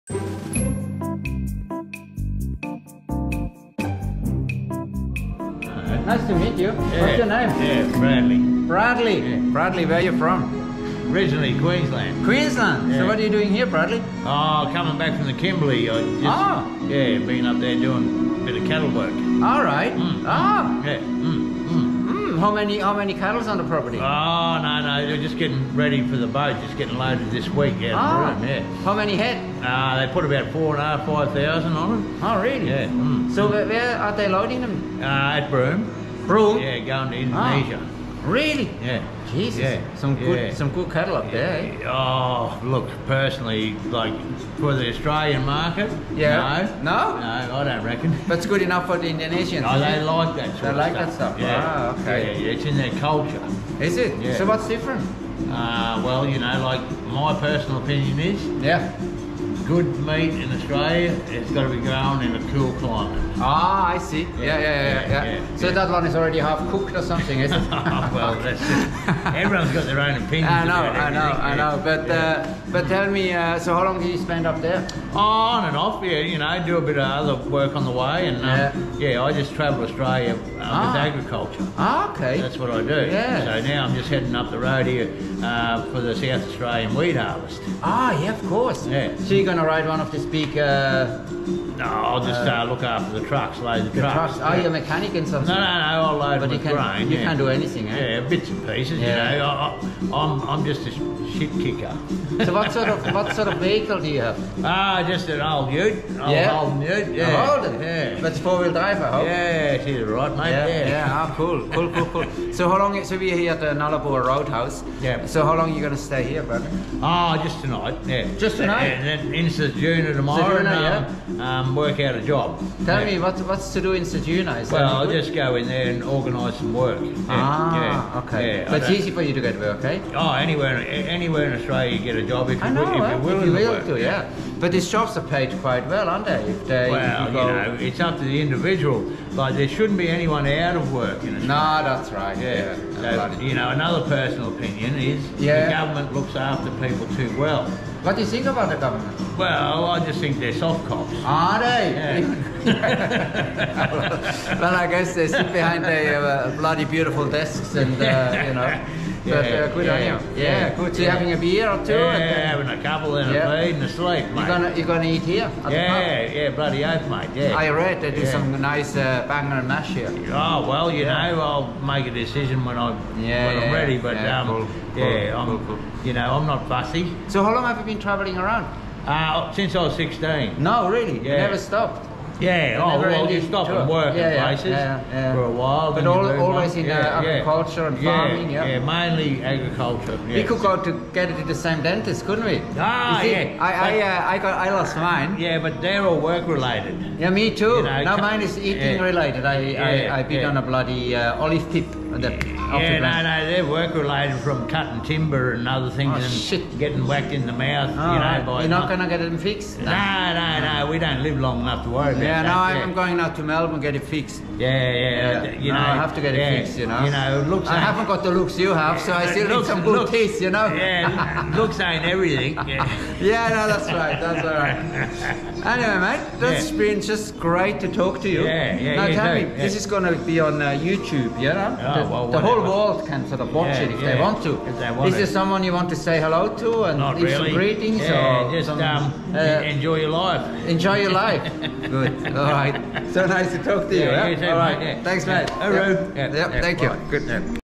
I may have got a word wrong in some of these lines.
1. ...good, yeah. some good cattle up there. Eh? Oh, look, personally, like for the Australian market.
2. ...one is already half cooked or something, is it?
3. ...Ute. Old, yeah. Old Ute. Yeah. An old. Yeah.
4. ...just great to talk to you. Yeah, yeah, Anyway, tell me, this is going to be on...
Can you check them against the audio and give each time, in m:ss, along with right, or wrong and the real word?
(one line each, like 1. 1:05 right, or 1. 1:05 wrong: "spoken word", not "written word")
1. 0:40 right
2. 1:05 right
3. 1:45 right
4. 3:47 wrong: "Now", not "Anyway".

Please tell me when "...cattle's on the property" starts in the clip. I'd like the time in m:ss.
0:23.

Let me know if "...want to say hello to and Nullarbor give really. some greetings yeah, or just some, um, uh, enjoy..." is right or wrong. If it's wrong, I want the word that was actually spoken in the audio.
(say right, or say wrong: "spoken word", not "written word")
wrong: "Not", not "Nullarbor".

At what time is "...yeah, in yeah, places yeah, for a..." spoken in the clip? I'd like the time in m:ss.
3:04.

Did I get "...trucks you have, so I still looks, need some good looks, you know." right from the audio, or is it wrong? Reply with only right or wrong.
wrong.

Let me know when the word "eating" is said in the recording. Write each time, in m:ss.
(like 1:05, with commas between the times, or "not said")
3:18.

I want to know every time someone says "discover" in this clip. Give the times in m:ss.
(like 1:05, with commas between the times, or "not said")
not said.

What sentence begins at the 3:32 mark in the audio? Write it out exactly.
No, yeah, no, I'm going out to Melbourne get it fixed.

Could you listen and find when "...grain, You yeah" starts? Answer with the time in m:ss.
1:36.